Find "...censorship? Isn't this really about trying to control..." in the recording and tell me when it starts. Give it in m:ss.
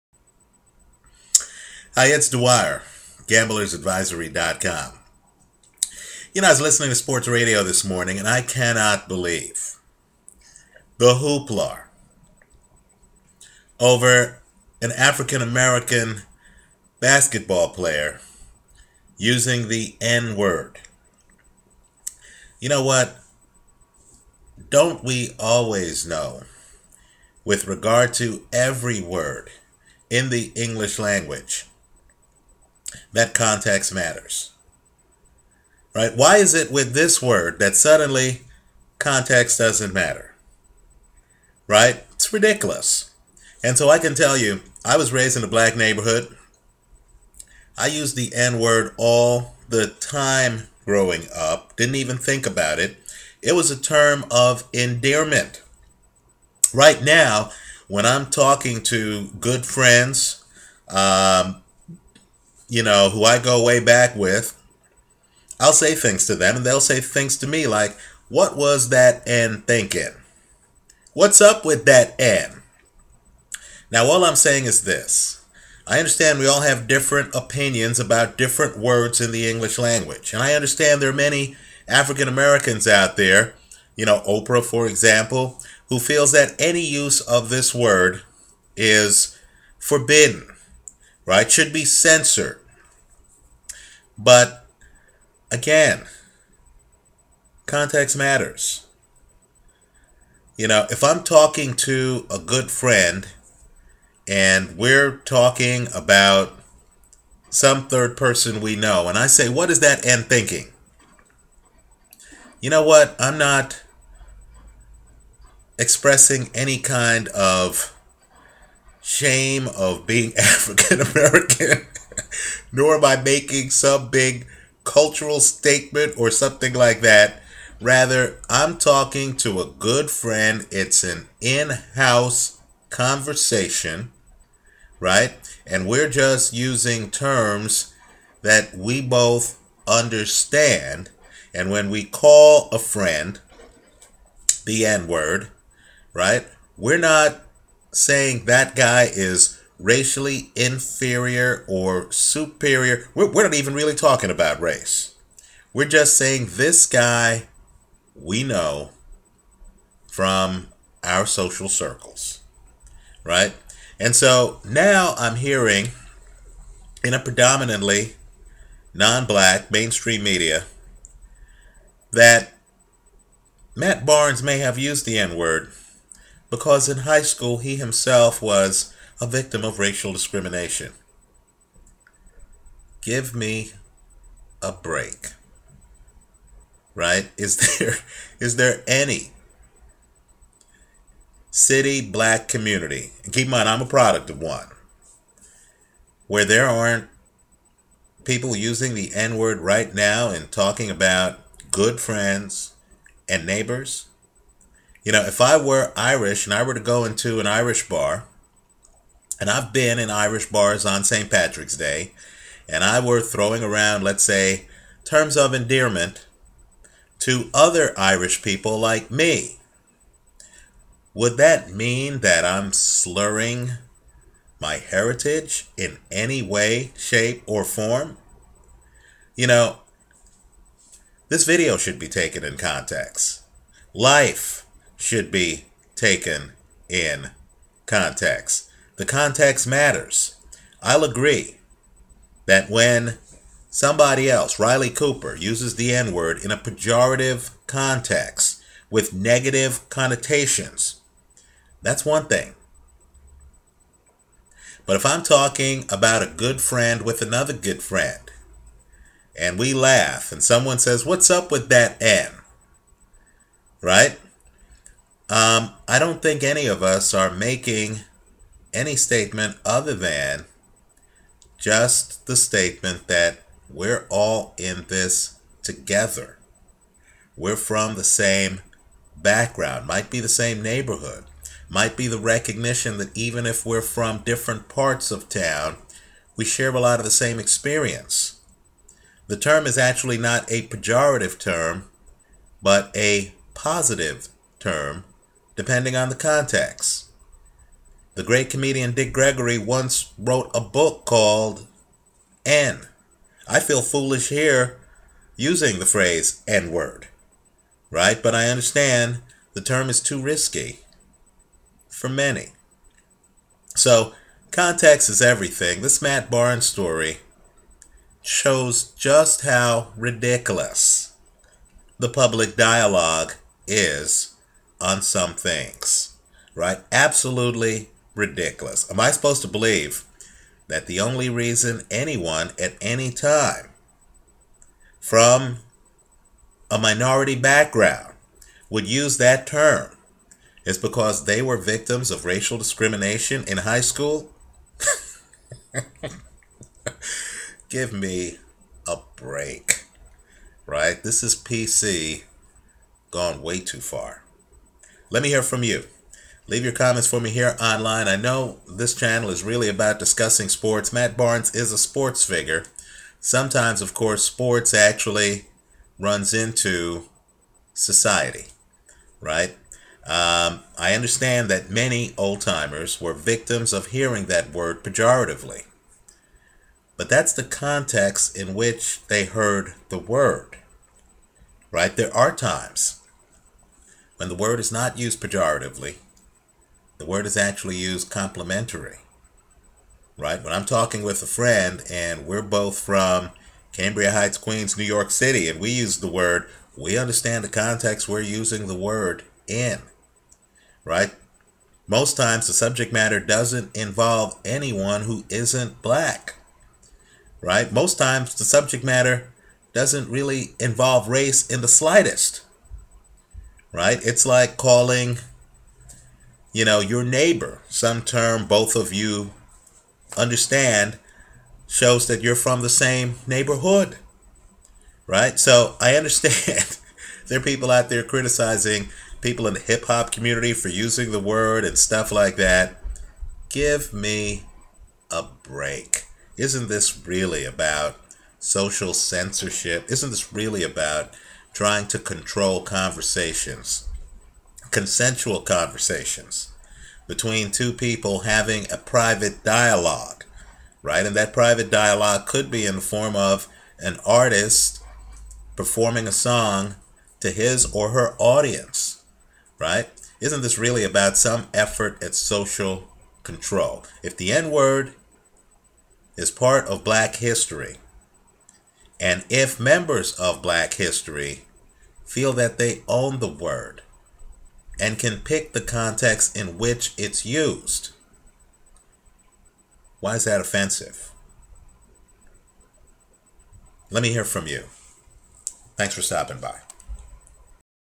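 7:18.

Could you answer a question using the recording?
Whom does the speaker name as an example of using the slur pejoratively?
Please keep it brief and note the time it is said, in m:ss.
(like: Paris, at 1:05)
Riley Cooper, at 4:04.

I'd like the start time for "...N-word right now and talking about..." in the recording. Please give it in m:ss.
3:19.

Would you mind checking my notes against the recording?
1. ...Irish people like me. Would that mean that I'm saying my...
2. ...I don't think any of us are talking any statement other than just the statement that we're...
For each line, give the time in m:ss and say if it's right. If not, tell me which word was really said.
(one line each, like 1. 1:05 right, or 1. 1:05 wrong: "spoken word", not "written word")
1. 3:37 wrong: "slurring", not "saying"
2. 4:25 wrong: "making", not "talking".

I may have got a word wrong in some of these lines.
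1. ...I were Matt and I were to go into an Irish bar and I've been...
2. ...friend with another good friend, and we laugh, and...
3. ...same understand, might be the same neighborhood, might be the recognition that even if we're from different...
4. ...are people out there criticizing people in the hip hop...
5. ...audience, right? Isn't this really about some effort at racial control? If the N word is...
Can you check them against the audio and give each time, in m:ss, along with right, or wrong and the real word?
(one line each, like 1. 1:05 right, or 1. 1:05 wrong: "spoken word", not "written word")
1. 3:25 wrong: "Irish", not "Matt"
2. 4:16 right
3. 4:38 wrong: "background", not "understand"
4. 7:07 right
5. 7:38 wrong: "social", not "racial".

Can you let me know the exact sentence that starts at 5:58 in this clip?
I know this channel is really about discussing sports.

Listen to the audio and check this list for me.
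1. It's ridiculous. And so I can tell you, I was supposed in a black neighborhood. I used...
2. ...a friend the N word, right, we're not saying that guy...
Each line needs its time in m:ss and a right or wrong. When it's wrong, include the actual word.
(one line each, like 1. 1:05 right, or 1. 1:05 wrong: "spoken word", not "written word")
1. 0:42 wrong: "raised", not "supposed"
2. 2:22 right.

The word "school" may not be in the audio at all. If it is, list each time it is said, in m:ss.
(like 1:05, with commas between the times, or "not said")
2:57, 5:43.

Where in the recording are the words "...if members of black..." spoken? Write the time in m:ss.
7:49.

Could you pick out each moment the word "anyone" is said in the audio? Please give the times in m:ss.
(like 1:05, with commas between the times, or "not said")
5:31, 6:44.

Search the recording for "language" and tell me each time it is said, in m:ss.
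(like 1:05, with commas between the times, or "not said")
0:30, 1:19.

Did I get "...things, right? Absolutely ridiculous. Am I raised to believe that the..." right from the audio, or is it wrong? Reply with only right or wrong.
wrong.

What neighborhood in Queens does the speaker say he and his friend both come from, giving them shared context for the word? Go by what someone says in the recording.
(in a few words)
Cambria Heights.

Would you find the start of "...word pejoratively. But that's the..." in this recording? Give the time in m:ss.
6:14.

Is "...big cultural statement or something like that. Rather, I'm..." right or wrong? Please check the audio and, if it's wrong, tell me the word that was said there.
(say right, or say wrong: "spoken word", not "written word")
right.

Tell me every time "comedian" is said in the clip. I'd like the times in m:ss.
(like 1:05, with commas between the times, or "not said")
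4:58.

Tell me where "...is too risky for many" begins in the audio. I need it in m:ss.
5:09.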